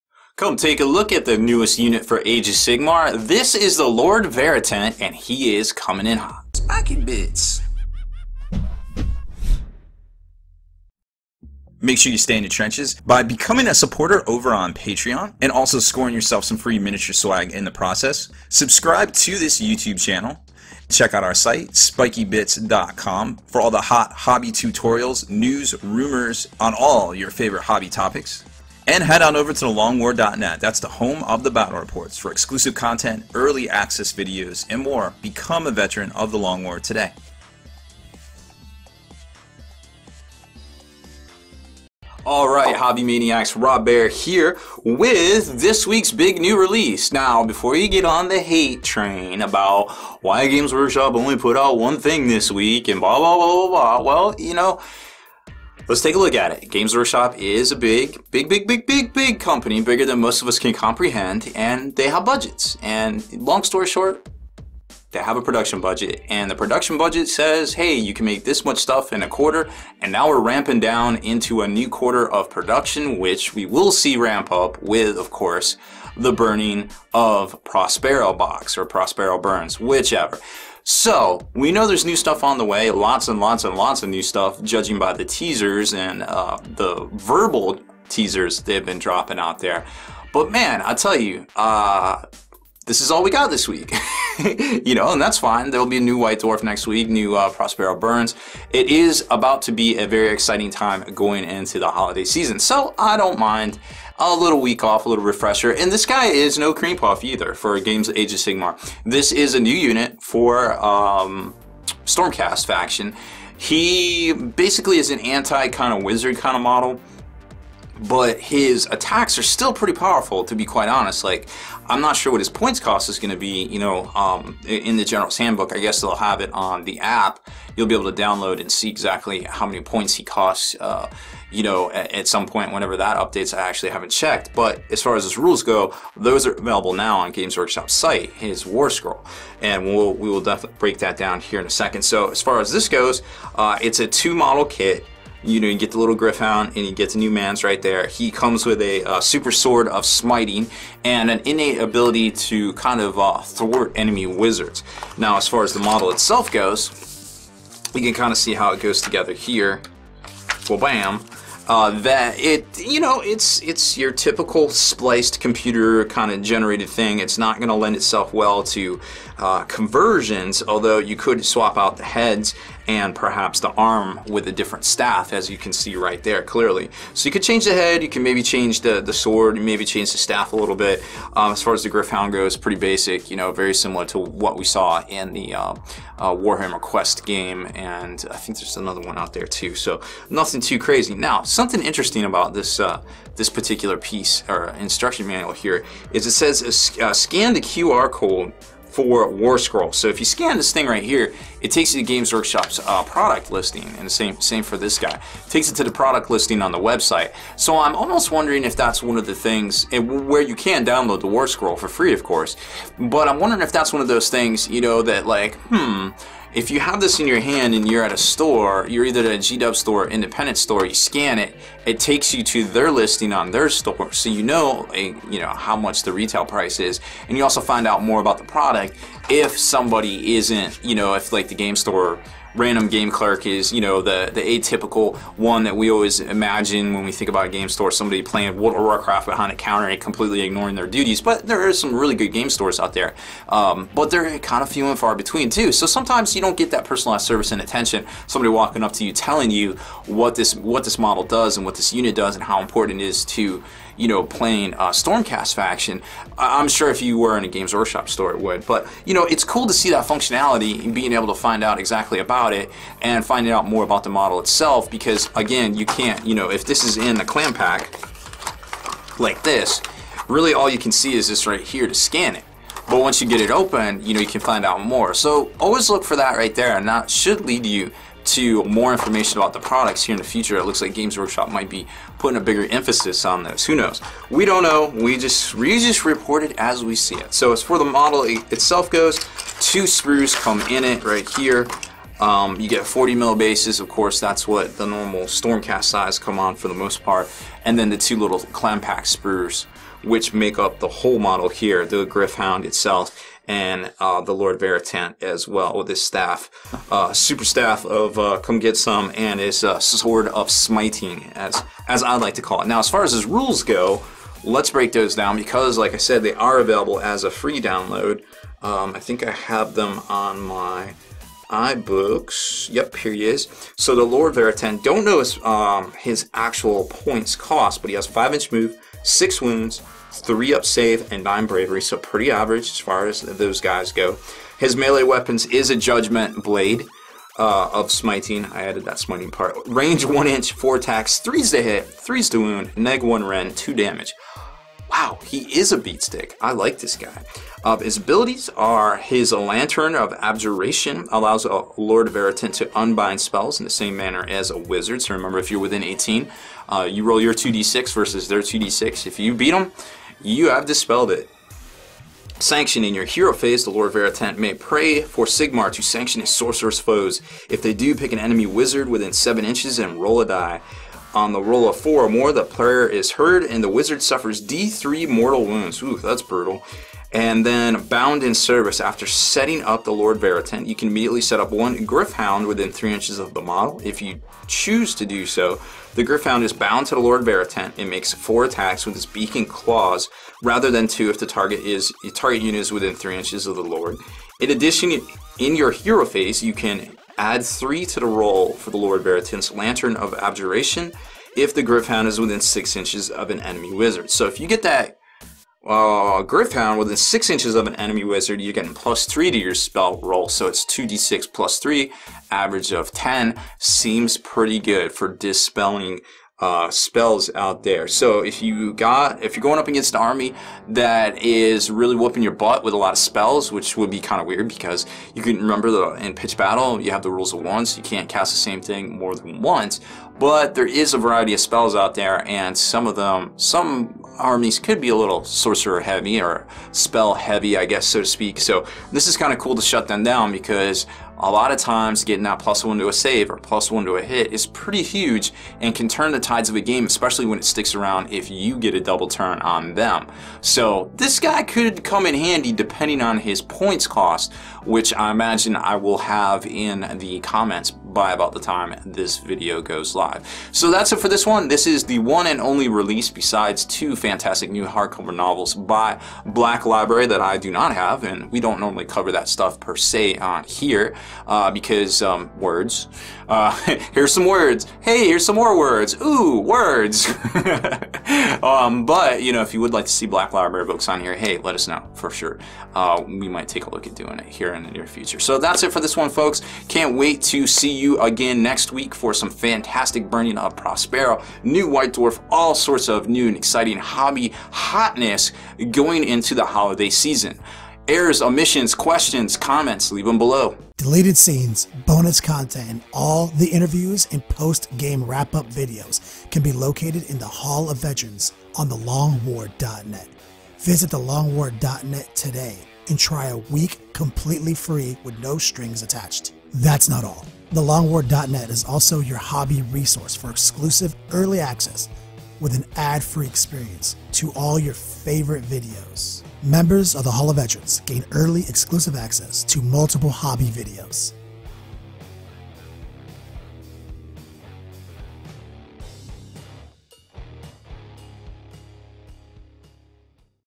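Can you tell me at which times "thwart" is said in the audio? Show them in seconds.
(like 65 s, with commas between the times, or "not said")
153 s.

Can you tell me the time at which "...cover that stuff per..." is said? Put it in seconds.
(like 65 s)
468 s.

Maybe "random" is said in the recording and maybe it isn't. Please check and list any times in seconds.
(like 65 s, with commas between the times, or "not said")
232 s.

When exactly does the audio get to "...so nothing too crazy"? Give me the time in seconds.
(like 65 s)
189 s.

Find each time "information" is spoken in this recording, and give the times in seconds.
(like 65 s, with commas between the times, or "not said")
278 s.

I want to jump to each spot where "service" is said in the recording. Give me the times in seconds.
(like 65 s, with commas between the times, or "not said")
247 s, 378 s.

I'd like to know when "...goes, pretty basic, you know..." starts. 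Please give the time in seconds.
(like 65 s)
182 s.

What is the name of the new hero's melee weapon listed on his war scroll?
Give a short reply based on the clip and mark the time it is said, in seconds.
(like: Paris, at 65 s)
Judgment Blade, at 335 s.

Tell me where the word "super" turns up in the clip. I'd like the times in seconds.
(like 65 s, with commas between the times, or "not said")
149 s, 307 s.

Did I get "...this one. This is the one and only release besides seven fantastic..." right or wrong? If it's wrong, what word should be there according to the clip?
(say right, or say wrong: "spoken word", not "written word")
wrong: "two", not "seven".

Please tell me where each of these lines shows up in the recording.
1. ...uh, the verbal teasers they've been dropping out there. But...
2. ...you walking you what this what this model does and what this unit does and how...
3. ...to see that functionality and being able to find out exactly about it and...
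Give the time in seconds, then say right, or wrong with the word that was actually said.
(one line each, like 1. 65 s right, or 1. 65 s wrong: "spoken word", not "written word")
1. 86 s right
2. 249 s wrong: "telling", not "walking"
3. 259 s right.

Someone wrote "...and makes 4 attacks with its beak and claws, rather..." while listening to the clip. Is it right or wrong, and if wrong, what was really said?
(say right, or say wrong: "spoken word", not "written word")
right.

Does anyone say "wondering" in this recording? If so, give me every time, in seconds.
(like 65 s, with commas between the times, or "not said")
208 s, 213 s.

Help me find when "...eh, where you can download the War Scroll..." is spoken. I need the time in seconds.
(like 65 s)
209 s.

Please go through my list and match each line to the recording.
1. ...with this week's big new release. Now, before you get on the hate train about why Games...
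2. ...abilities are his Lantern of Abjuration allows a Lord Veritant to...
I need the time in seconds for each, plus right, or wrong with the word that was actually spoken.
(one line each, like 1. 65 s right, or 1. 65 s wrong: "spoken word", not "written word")
1. 44 s right
2. 347 s right.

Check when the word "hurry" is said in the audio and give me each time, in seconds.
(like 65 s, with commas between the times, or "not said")
not said.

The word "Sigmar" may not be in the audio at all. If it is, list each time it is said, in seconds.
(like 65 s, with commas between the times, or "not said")
2 s, 108 s, 365 s.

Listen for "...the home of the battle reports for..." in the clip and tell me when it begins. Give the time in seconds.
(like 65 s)
30 s.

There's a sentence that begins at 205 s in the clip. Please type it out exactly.
It takes it to the product listing on the website.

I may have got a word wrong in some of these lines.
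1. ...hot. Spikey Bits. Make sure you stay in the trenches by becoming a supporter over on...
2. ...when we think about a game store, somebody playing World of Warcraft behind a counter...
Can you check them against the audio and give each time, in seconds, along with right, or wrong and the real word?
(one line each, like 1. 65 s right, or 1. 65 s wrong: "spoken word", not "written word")
1. 6 s right
2. 236 s right.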